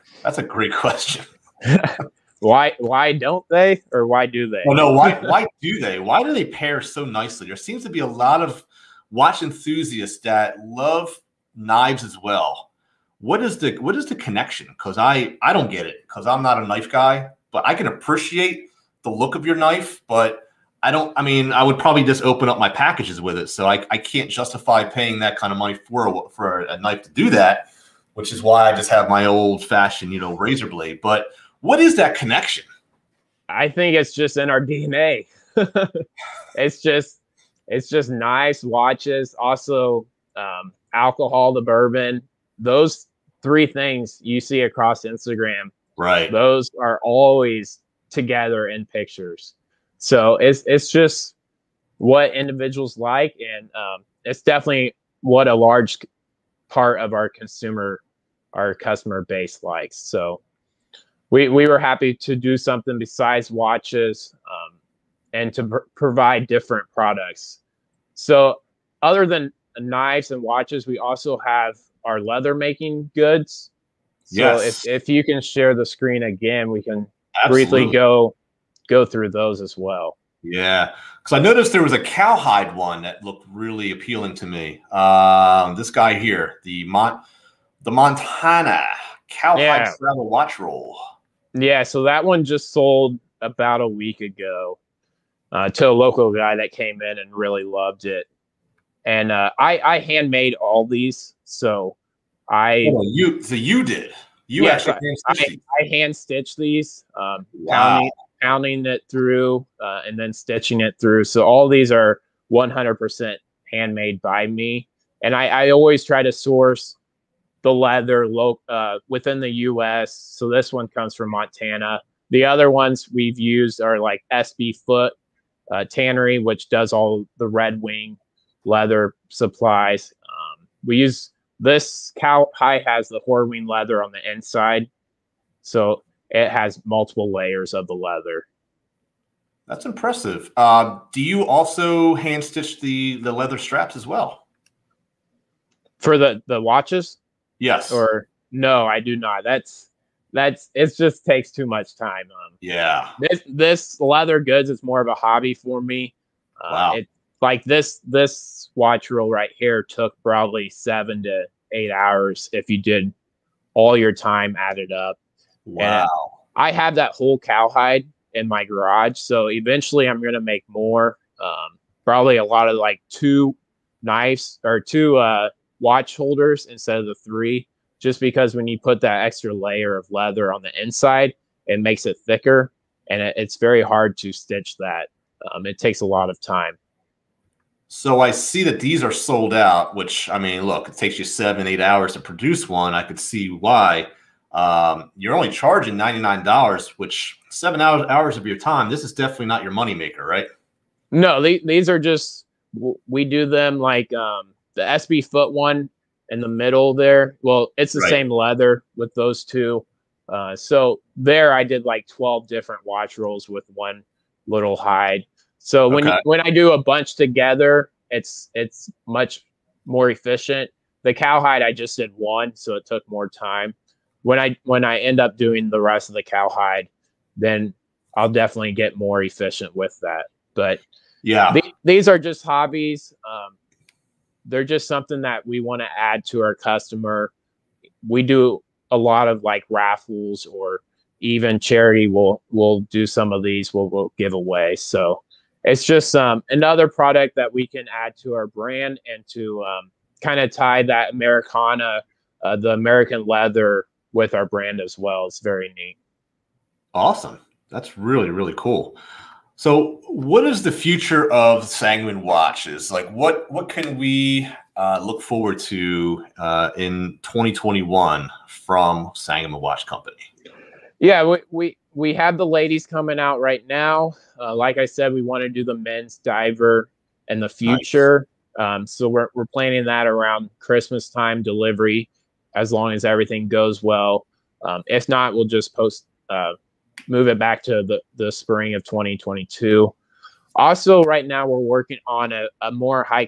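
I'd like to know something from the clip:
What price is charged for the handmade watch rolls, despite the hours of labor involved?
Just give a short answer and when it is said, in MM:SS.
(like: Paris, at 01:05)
$99, at 03:15.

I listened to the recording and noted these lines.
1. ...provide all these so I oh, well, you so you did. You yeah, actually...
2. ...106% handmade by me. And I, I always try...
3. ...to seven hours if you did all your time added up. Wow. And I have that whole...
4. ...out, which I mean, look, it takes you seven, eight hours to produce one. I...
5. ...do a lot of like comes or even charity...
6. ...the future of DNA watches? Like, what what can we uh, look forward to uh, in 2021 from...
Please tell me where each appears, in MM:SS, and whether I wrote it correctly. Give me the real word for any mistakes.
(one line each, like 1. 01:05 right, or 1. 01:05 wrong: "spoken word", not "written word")
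1. 01:39 wrong: "handmade", not "provide"
2. 01:52 wrong: "100", not "106"
3. 02:41 wrong: "eight", not "seven"
4. 03:09 right
5. 03:58 wrong: "raffles", not "comes"
6. 04:20 wrong: "Sangamon", not "DNA".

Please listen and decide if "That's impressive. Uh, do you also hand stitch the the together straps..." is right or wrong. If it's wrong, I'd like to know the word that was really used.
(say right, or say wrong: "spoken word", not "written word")
wrong: "leather", not "together".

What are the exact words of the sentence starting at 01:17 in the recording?
briefly go go through those as well.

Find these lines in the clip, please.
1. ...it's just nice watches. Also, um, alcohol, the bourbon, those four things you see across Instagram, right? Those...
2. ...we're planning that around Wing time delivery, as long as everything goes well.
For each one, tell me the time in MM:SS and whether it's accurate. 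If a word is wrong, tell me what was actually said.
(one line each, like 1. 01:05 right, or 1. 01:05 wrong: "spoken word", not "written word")
1. 00:37 wrong: "three", not "four"
2. 04:39 wrong: "Christmas", not "Wing".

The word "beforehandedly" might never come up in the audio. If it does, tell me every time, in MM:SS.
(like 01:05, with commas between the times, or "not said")
not said.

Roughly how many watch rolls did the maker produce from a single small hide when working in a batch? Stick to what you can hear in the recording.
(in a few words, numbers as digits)
12.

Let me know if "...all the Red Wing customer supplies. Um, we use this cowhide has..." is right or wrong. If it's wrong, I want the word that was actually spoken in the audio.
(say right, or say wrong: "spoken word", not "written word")
wrong: "leather", not "customer".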